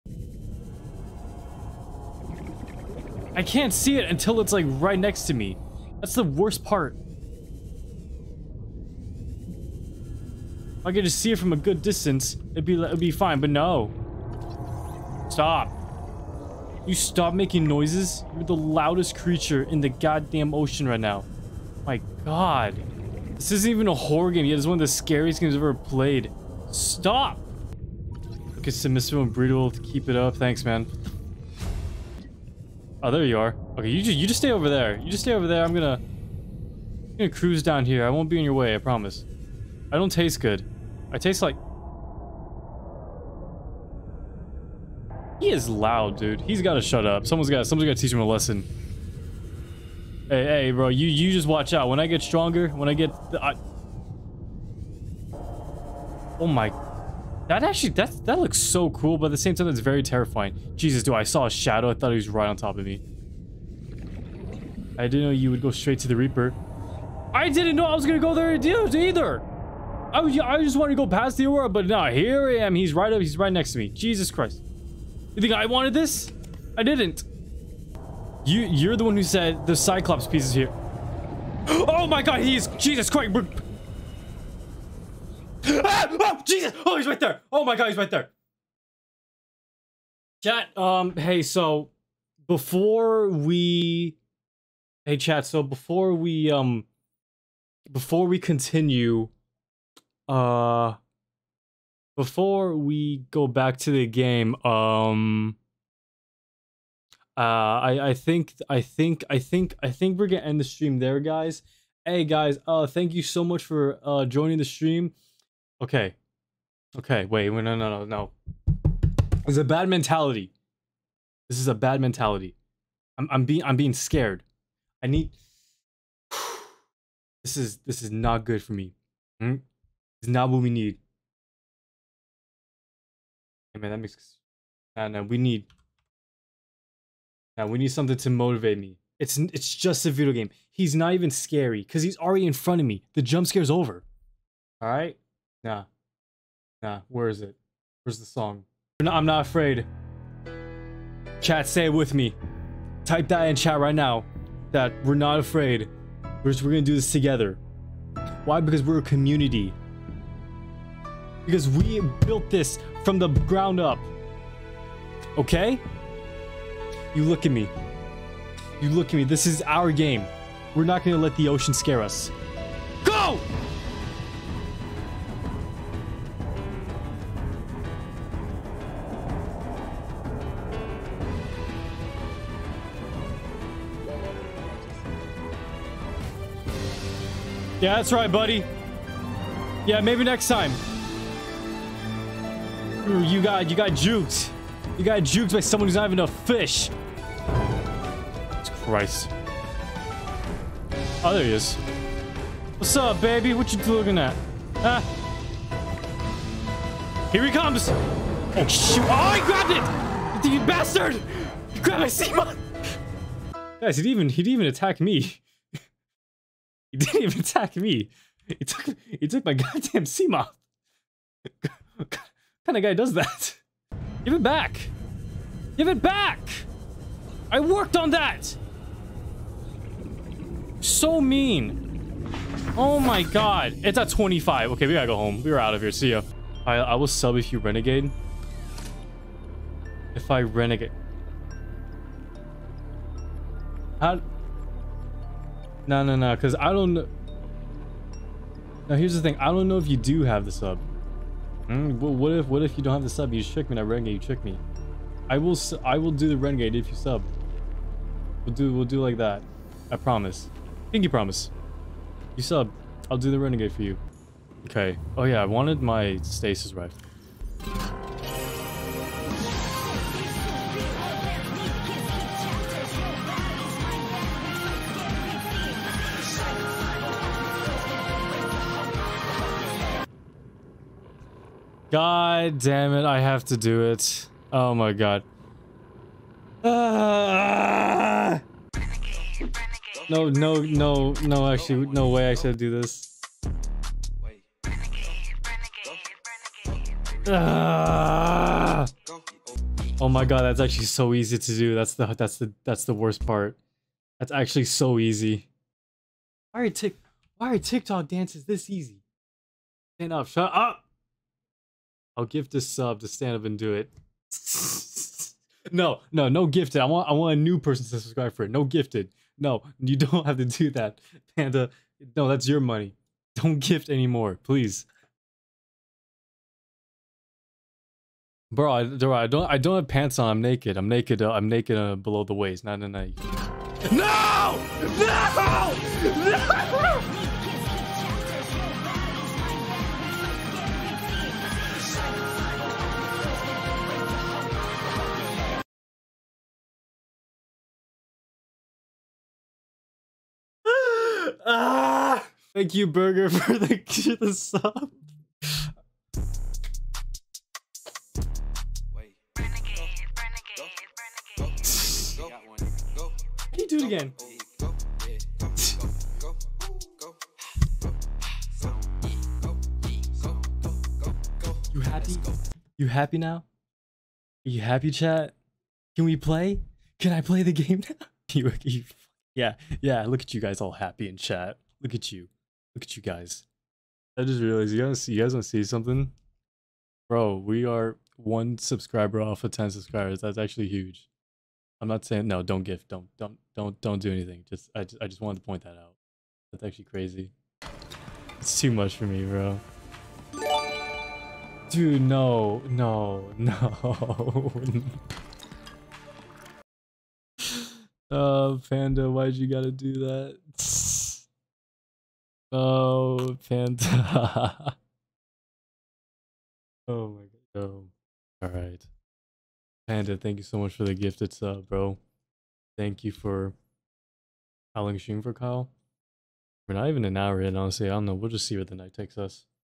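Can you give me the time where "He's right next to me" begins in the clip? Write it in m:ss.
1:13.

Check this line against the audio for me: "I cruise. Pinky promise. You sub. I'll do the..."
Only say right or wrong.
wrong.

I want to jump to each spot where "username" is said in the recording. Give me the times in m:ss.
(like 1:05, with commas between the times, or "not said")
not said.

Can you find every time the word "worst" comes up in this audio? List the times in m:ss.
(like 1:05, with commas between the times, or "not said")
0:06, 5:02.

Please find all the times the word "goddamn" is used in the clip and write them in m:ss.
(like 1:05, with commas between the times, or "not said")
0:19, 3:39.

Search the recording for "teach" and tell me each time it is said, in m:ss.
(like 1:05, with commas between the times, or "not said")
0:47.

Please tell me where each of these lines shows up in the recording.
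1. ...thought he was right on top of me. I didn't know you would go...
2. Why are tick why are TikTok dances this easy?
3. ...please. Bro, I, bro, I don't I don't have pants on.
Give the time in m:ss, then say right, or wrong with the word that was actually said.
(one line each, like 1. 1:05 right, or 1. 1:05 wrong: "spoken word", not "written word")
1. 1:01 right
2. 5:06 right
3. 5:24 right.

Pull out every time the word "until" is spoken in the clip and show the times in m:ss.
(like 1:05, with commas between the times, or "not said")
0:04.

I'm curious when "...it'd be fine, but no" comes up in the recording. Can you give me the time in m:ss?
0:12.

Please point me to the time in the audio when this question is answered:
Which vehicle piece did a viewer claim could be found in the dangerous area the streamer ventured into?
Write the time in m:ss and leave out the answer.
1:19.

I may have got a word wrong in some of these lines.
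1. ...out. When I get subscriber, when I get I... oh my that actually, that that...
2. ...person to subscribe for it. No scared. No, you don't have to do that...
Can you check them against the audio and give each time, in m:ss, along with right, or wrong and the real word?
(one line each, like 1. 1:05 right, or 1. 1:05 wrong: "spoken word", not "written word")
1. 0:51 wrong: "stronger", not "subscriber"
2. 5:17 wrong: "gifted", not "scared".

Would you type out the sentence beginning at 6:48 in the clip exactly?
Oh, Panda, why'd you gotta do that?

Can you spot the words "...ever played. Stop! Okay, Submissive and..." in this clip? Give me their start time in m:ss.
0:25.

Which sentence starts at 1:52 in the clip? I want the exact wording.
Hey guys, uh thank you so much for uh joining the stream.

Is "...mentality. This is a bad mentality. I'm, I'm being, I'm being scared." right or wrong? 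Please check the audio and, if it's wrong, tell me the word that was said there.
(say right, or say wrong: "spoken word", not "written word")
right.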